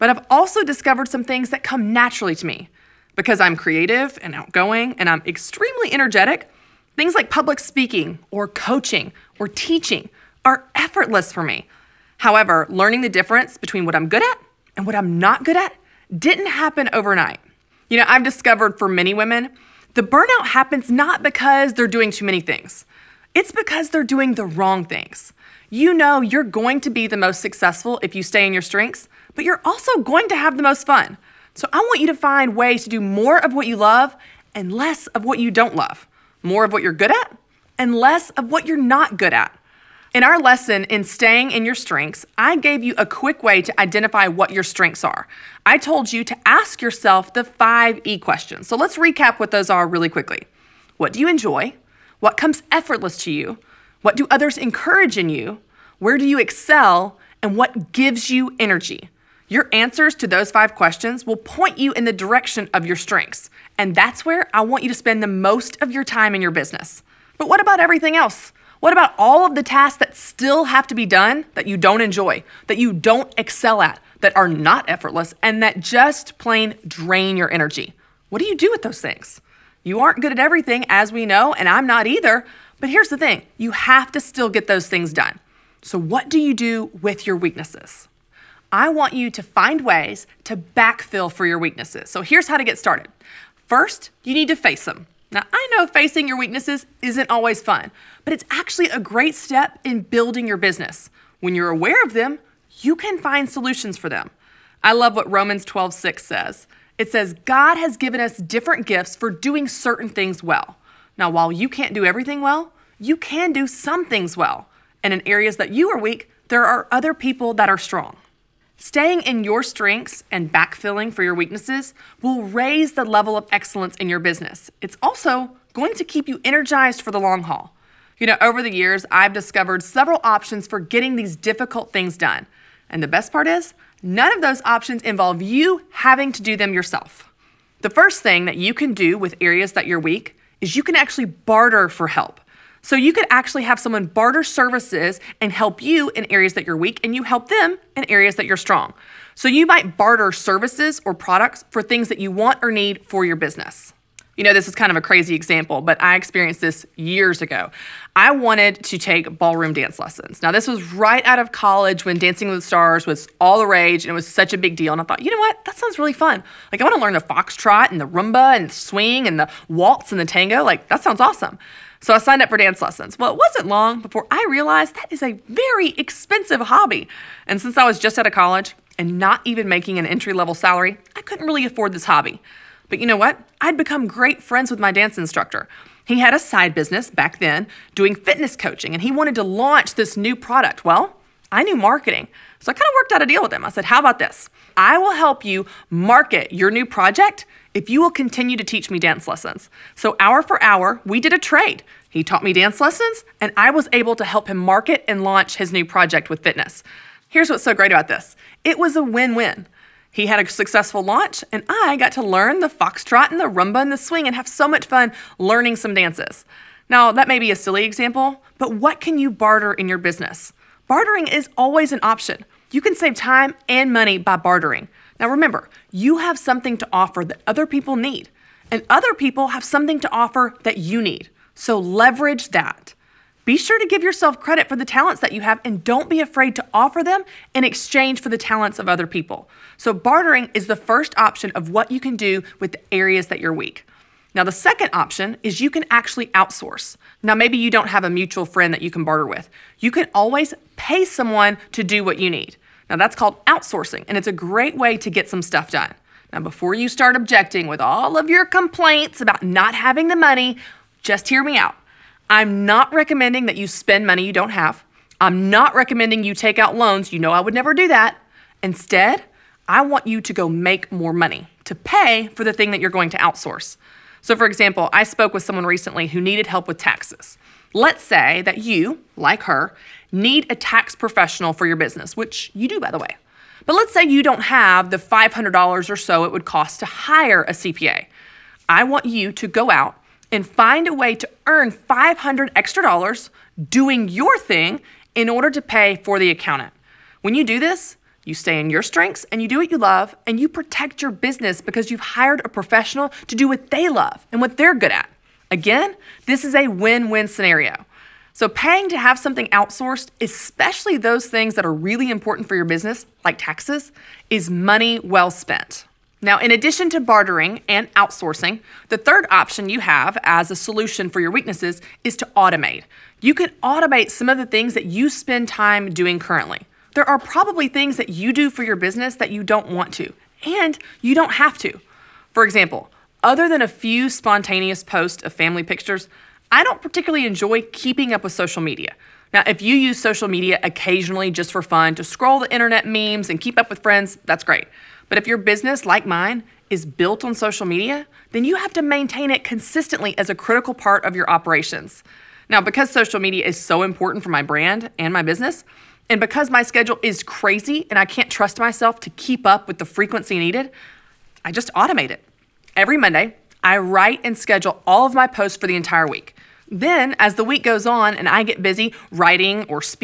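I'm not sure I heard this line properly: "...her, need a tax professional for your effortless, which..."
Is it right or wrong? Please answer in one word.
wrong.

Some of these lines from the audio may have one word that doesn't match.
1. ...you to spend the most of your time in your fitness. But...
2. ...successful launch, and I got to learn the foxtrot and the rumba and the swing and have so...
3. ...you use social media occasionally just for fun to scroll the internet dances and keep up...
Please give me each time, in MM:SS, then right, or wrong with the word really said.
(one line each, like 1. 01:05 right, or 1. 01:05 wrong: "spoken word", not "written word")
1. 01:04 wrong: "business", not "fitness"
2. 03:30 right
3. 05:39 wrong: "memes", not "dances".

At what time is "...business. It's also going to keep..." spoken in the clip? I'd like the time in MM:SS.
02:04.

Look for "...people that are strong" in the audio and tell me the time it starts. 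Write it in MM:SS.
01:57.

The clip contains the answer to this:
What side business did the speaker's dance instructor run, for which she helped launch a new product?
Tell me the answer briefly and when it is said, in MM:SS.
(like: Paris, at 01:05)
Fitness coaching, at 03:08.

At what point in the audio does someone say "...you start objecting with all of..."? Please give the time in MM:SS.
04:16.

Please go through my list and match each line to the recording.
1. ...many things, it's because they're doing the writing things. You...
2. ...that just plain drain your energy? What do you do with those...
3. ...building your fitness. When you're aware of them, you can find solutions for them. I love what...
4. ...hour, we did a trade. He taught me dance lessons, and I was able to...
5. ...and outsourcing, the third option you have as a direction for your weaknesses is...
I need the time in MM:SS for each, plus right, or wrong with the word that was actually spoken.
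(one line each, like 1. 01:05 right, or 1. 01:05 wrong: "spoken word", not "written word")
1. 00:22 wrong: "wrong", not "writing"
2. 01:15 right
3. 01:40 wrong: "business", not "fitness"
4. 03:20 right
5. 05:17 wrong: "solution", not "direction".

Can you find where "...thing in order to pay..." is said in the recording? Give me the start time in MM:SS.
04:54.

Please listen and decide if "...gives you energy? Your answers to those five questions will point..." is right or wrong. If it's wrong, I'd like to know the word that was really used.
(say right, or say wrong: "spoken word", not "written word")
right.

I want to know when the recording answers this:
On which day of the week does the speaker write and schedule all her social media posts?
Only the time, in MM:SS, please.
06:02.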